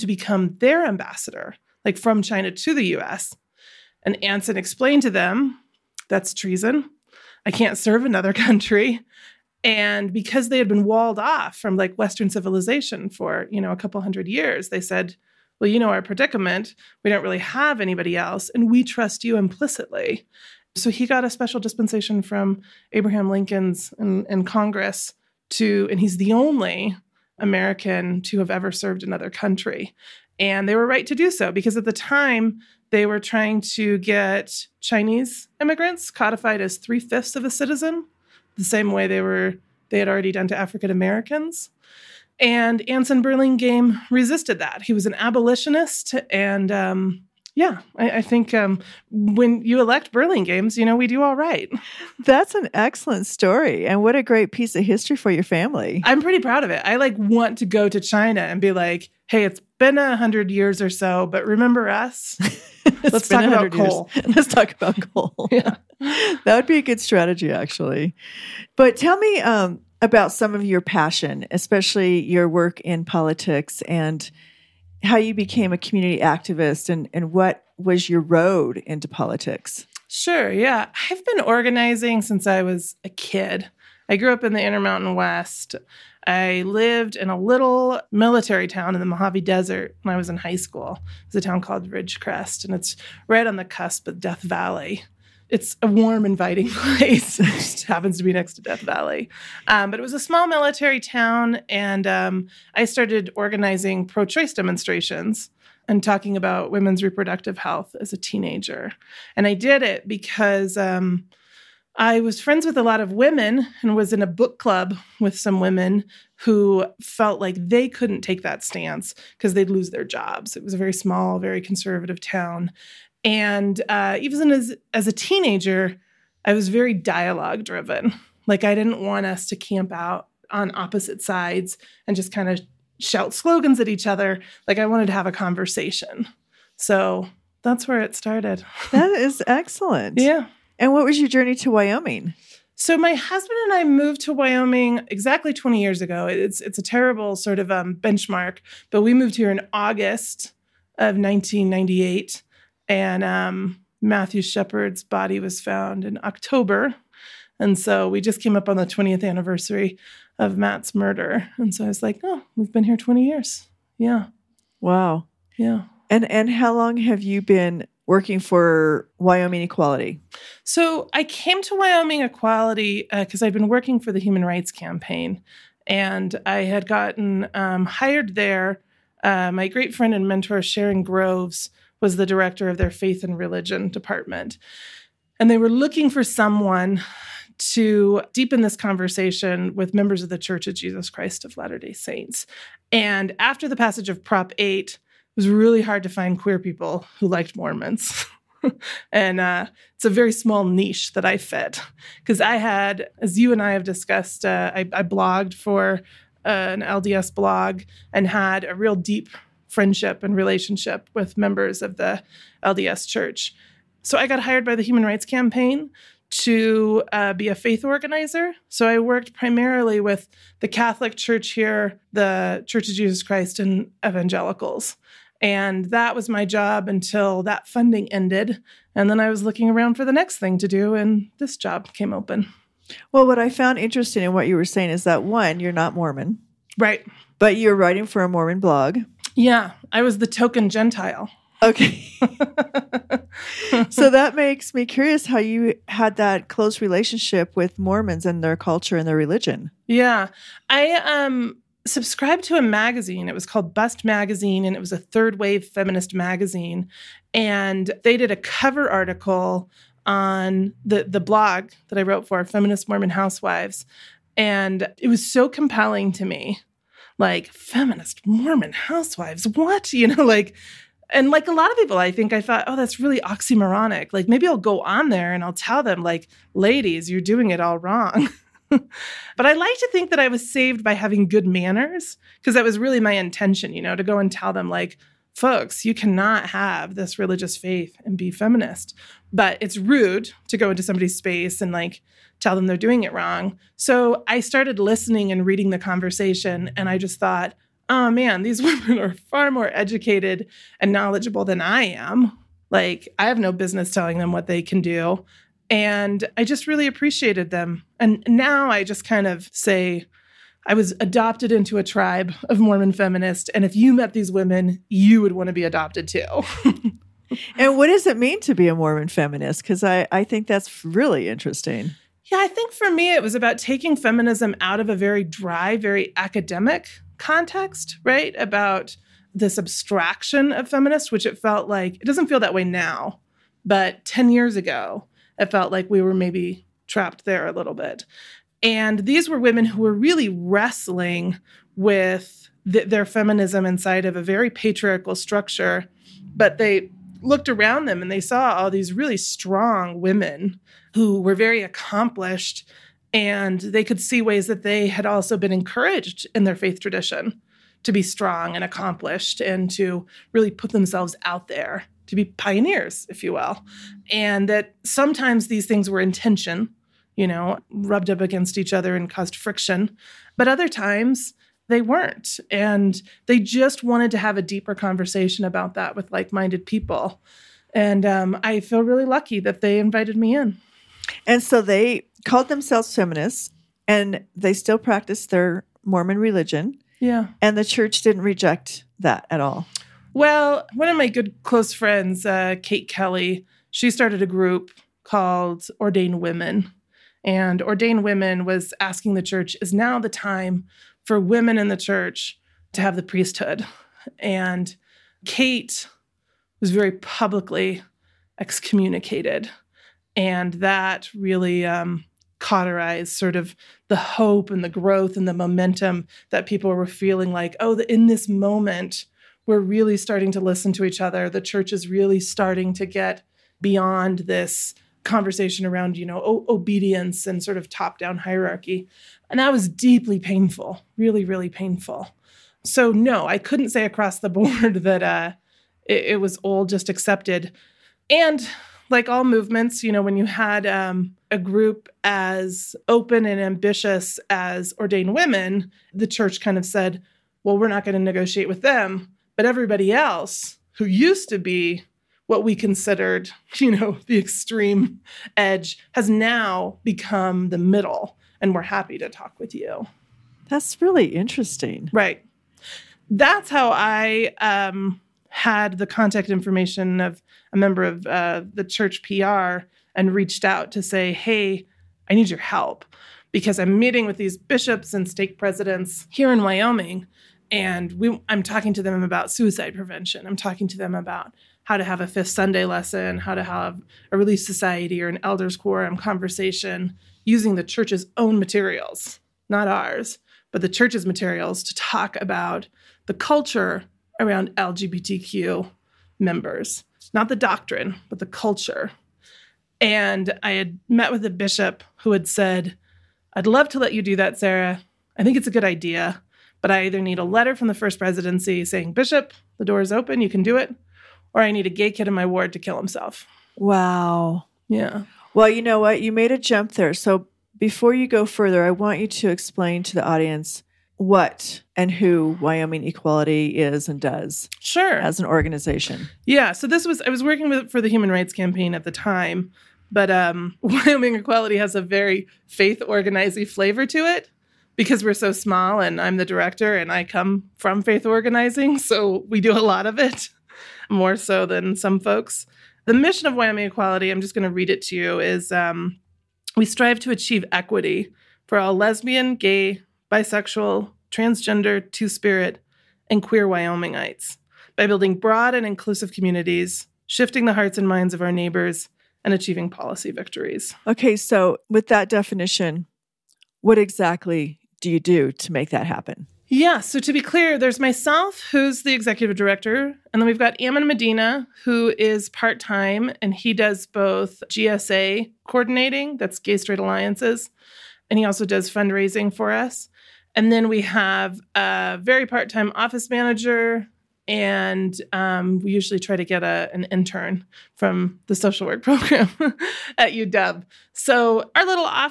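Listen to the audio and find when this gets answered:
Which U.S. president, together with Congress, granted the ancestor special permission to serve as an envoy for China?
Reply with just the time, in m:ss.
0:22.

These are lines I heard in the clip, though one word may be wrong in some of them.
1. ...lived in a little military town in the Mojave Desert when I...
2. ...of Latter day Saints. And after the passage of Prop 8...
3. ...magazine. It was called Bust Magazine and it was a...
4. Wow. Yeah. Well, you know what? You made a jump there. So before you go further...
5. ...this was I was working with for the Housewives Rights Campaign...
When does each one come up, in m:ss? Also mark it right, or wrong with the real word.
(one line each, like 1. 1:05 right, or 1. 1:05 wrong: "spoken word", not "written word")
1. 1:26 right
2. 3:11 right
3. 4:12 right
4. 8:33 right
5. 8:46 wrong: "Human", not "Housewives".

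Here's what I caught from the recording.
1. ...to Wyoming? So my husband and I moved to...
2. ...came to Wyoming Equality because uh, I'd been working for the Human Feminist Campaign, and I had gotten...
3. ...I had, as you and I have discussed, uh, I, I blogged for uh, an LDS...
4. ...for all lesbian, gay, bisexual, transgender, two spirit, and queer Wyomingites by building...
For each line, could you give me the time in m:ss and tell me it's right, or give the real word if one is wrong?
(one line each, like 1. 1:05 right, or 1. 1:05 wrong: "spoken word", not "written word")
1. 2:21 right
2. 2:51 wrong: "Rights", not "Feminist"
3. 3:22 right
4. 9:08 right.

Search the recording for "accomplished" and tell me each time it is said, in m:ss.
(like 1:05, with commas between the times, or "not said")
5:51, 5:58.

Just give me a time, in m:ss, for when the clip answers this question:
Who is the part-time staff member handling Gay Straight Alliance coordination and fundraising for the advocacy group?
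9:30.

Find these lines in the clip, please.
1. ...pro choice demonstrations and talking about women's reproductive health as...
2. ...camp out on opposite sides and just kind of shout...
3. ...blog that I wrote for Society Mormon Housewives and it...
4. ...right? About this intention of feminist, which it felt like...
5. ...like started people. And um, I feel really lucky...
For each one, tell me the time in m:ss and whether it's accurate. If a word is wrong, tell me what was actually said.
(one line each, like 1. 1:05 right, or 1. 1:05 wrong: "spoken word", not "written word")
1. 1:44 right
2. 2:09 right
3. 4:21 wrong: "Feminist", not "Society"
4. 5:28 wrong: "abstraction", not "intention"
5. 6:16 wrong: "minded", not "started".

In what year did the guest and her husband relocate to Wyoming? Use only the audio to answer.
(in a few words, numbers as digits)
1998.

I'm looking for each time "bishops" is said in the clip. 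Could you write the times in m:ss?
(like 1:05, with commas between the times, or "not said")
7:54, 8:21, 8:28.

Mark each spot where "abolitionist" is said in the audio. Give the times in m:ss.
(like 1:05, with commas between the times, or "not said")
0:45.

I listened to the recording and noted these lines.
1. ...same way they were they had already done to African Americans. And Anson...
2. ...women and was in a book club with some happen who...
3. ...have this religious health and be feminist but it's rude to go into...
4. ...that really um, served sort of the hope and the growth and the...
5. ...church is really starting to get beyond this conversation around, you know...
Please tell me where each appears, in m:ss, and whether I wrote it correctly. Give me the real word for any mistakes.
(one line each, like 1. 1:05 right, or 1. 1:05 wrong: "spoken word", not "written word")
1. 0:38 right
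2. 1:53 wrong: "women", not "happen"
3. 4:46 wrong: "faith", not "health"
4. 6:50 wrong: "cauterized", not "served"
5. 7:01 right.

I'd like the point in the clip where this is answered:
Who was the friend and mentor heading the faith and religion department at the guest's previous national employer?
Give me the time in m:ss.
3:00.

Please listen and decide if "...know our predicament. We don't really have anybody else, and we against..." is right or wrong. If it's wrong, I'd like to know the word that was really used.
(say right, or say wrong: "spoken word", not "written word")
wrong: "trust", not "against".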